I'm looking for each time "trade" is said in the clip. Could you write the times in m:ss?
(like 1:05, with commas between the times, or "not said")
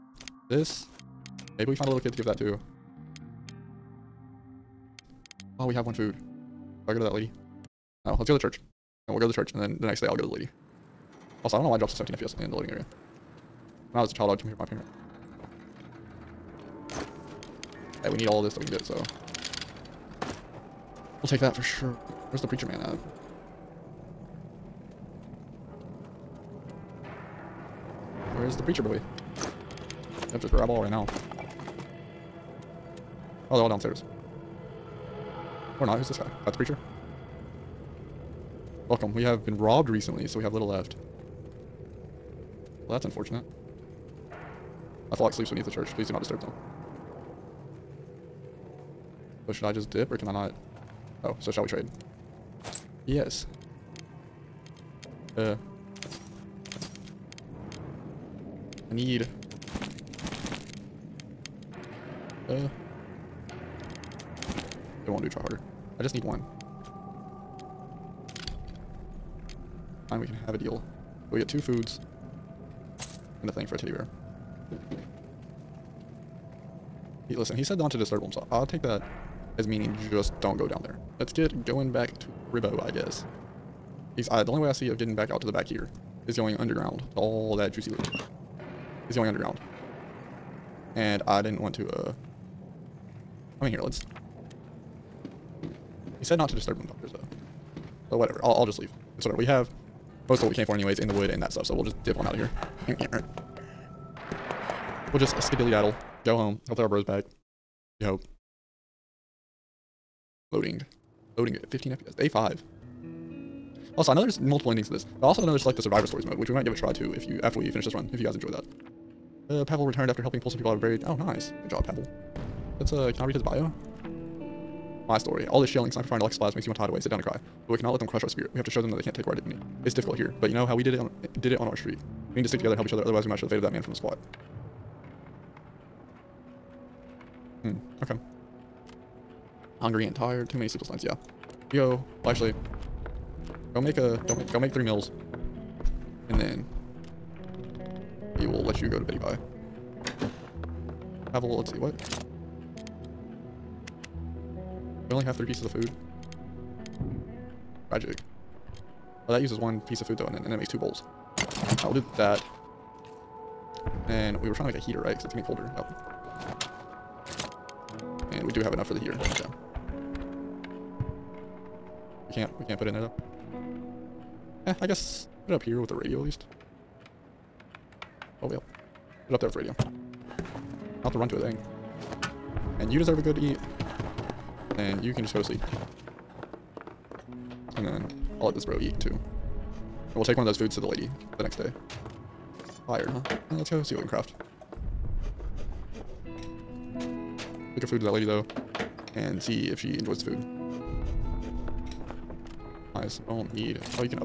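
0:51.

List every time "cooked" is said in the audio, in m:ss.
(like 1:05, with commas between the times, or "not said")
not said.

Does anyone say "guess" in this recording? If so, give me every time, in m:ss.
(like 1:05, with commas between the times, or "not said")
1:22, 2:54.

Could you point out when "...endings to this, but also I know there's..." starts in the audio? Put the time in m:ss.
1:54.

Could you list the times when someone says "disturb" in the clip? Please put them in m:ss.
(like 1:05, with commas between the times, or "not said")
0:46, 1:17, 1:36.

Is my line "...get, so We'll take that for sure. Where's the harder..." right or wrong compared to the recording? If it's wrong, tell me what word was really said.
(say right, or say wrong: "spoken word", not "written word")
wrong: "preacher", not "harder".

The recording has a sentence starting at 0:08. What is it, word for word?
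Oh, let's go to the church.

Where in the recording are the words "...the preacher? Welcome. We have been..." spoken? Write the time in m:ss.
0:36.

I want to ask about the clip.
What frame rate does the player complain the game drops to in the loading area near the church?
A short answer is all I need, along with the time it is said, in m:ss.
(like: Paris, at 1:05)
17 FPS, at 0:11.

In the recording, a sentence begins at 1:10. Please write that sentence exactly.
Fine, we can have a deal.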